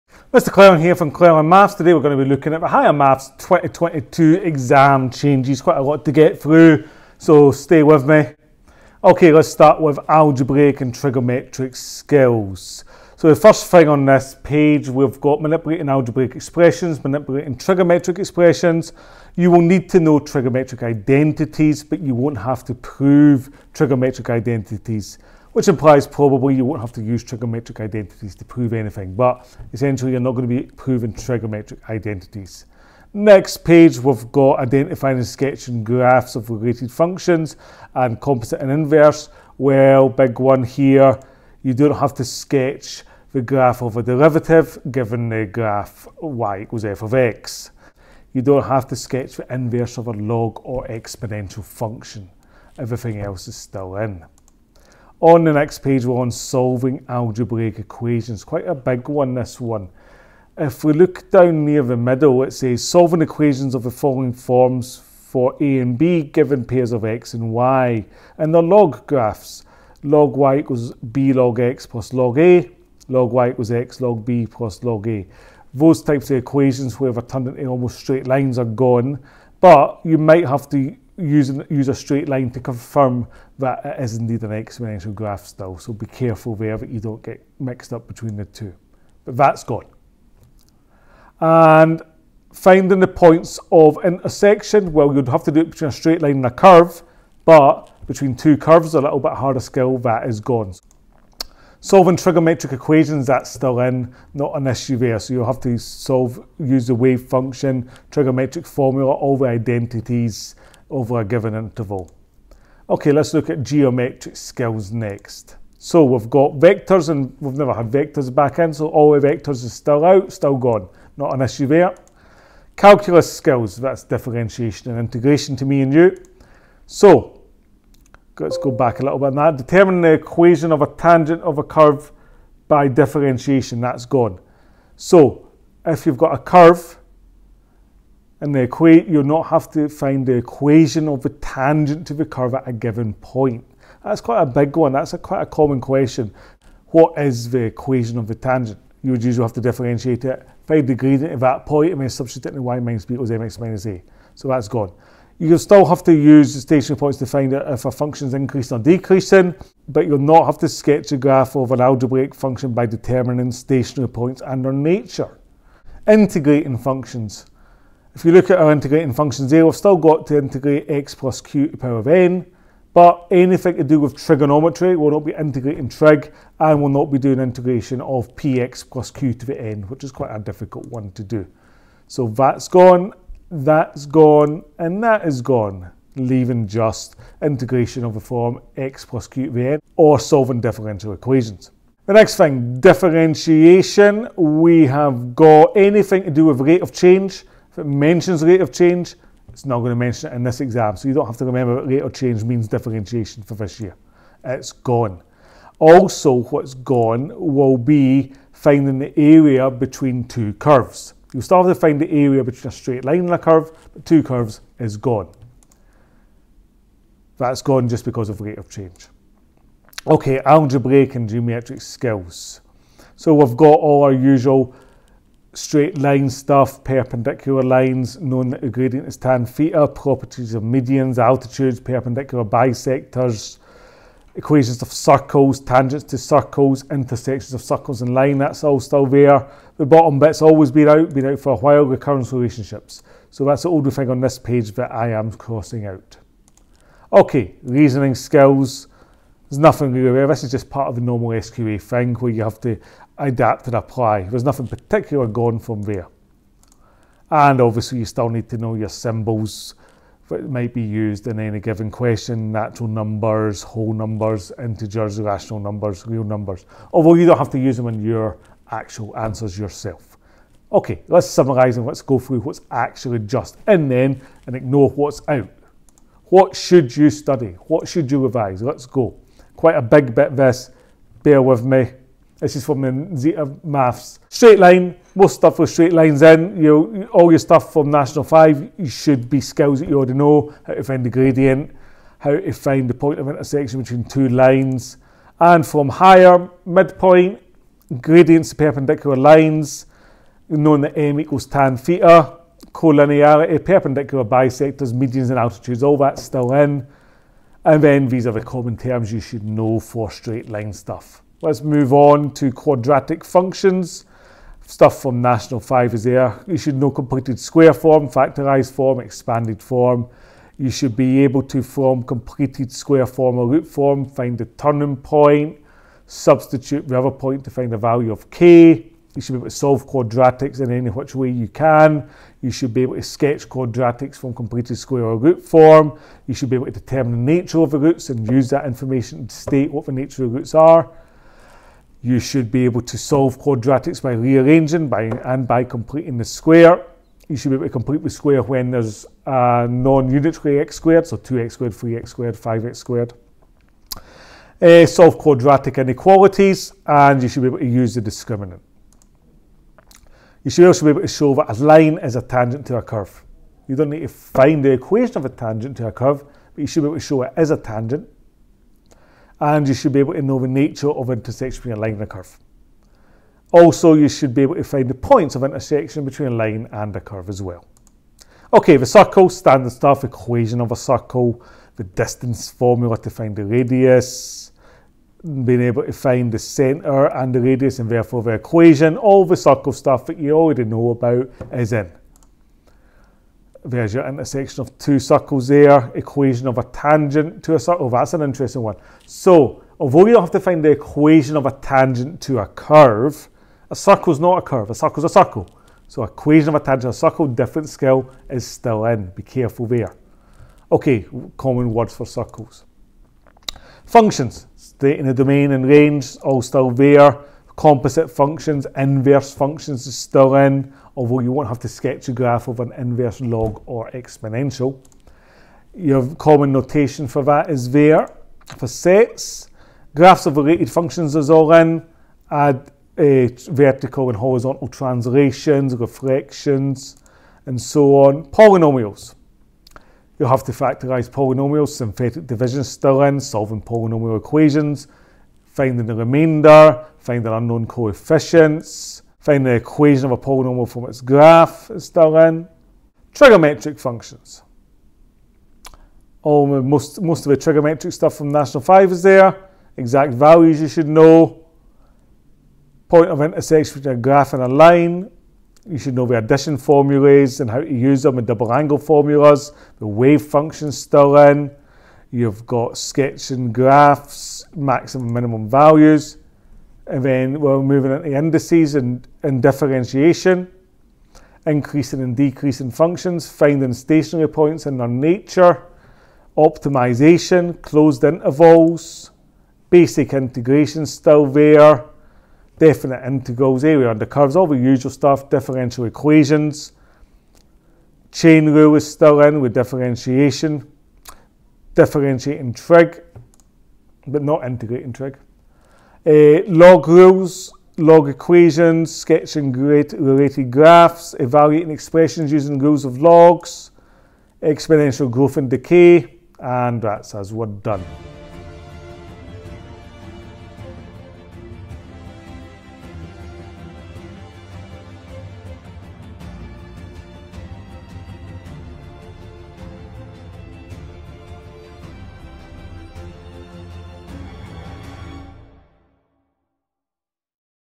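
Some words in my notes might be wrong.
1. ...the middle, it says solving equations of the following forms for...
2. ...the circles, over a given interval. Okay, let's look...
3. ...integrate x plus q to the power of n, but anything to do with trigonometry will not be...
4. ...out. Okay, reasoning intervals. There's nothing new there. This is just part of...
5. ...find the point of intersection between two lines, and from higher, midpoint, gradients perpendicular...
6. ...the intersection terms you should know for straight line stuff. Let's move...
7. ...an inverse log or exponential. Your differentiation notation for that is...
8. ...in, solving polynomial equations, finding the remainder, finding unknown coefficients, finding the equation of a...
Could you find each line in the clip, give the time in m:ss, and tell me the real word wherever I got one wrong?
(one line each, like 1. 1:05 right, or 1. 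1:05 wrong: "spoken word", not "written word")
1. 1:01 right
2. 1:49 wrong: "identities", not "circles"
3. 2:50 right
4. 4:05 wrong: "skills", not "intervals"
5. 4:52 right
6. 5:08 wrong: "common", not "intersection"
7. 7:02 wrong: "common", not "differentiation"
8. 7:23 right.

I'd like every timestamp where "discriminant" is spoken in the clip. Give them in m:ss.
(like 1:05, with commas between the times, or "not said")
5:58.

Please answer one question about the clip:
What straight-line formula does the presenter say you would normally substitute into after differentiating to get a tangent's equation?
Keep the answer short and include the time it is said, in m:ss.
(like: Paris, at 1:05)
y minus b equals m(x minus a), at 2:32.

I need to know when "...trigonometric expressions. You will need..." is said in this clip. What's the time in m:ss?
0:17.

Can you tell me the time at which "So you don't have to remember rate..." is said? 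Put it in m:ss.
3:20.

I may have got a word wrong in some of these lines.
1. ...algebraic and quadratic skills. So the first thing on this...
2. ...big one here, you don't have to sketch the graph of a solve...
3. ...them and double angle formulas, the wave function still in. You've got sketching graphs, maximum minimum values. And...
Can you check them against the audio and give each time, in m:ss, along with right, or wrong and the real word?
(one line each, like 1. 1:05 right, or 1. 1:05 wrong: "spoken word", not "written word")
1. 0:10 wrong: "trigonometric", not "quadratic"
2. 0:40 wrong: "derivative", not "solve"
3. 7:48 right.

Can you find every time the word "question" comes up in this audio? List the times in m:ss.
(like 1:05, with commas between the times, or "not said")
2:25, 4:21.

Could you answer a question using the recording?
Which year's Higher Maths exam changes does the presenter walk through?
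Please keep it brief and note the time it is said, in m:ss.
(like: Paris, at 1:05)
2022, at 0:03.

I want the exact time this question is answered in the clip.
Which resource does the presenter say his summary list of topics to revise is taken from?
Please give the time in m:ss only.
4:43.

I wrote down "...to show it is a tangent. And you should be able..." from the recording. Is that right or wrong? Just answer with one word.
right.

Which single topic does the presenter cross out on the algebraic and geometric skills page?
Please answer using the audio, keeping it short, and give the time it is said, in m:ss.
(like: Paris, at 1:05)
recurrence relationships, at 4:01.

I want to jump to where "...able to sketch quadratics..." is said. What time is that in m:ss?
5:32.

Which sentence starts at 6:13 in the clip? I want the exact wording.
Also, you should be able to find the points of intersection between a line and a curve as well.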